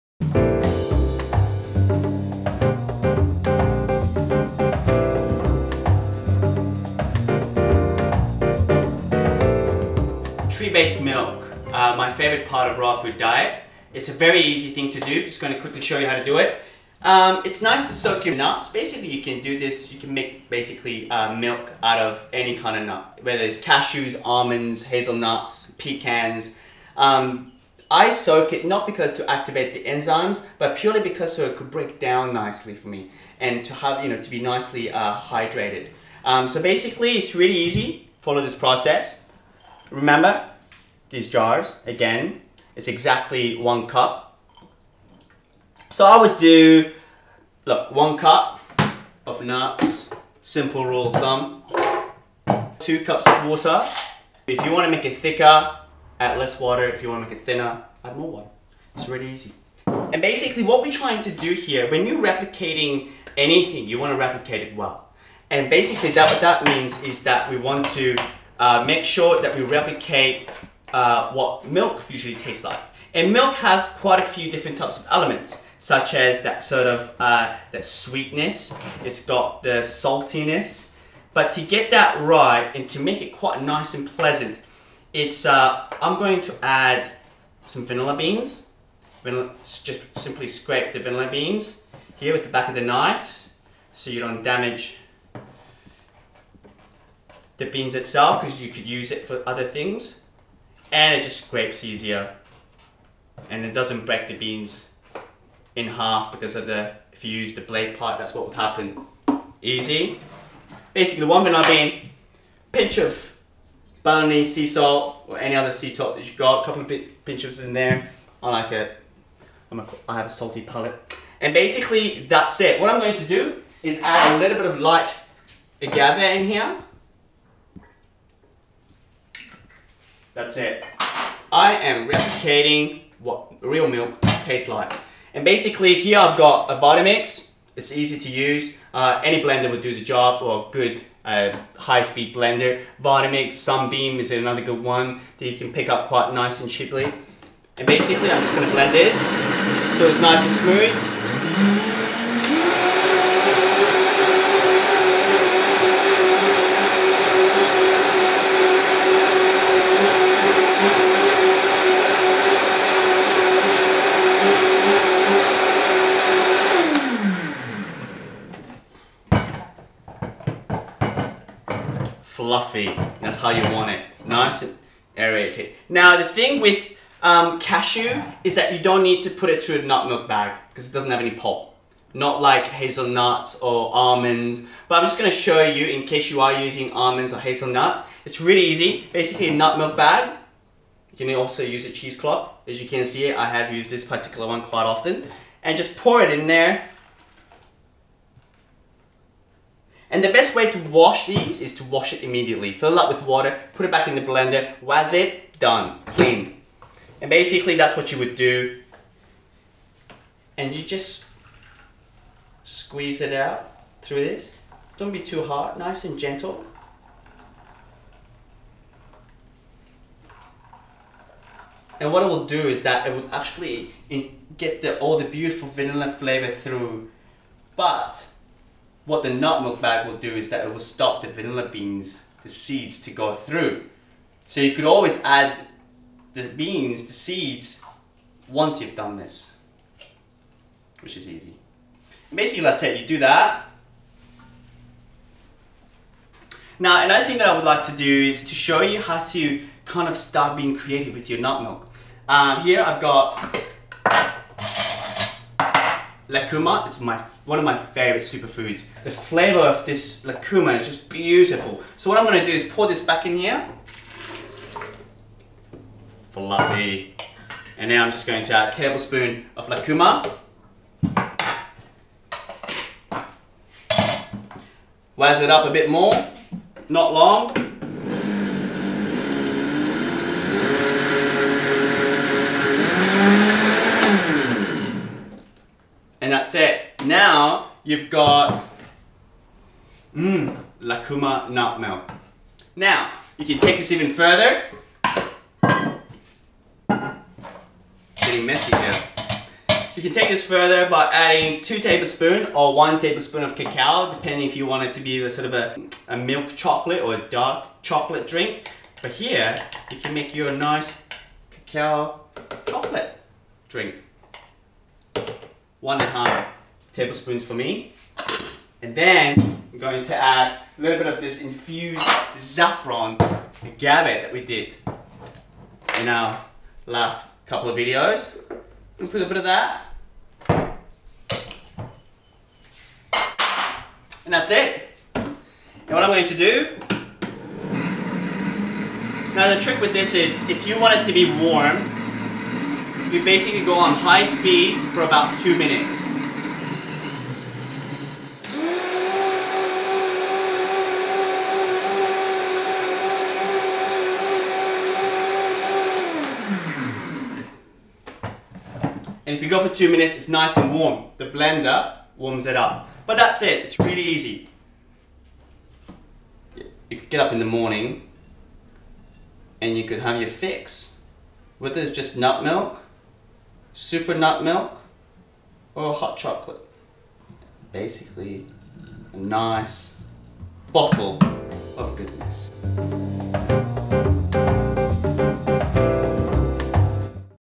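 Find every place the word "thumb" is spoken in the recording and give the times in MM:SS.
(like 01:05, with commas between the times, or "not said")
00:51.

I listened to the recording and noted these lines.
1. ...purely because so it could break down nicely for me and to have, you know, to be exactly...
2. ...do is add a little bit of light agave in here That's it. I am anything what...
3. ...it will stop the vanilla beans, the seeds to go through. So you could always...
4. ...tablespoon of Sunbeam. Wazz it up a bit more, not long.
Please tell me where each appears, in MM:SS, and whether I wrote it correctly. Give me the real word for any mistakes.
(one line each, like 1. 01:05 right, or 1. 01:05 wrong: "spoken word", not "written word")
1. 00:30 wrong: "nicely", not "exactly"
2. 02:03 wrong: "replicating", not "anything"
3. 03:50 right
4. 04:28 wrong: "Lucuma", not "Sunbeam".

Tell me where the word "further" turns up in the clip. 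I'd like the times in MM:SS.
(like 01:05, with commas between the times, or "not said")
04:54, 05:00.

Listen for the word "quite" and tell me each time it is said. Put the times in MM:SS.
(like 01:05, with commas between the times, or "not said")
01:13, 01:23, 02:26, 03:14.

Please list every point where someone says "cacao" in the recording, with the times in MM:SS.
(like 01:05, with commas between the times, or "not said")
05:03, 05:11.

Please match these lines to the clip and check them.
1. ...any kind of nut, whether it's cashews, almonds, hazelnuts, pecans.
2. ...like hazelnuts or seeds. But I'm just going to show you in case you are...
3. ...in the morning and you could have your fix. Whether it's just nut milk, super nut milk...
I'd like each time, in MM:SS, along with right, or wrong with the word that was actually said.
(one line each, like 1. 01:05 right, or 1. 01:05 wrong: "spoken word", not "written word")
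1. 00:22 right
2. 03:02 wrong: "almonds", not "seeds"
3. 06:07 right.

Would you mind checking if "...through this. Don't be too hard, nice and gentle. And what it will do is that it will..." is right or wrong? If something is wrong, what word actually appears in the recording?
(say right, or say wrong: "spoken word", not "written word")
right.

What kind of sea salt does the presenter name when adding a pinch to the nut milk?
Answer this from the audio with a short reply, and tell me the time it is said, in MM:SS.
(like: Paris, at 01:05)
Balinese sea salt, at 01:54.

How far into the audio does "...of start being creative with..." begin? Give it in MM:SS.
04:10.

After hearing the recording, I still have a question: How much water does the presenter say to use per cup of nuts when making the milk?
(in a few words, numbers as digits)
2 cups.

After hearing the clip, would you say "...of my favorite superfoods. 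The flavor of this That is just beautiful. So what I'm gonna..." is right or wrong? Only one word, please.
wrong.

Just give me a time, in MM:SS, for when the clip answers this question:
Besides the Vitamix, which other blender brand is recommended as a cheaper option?
02:23.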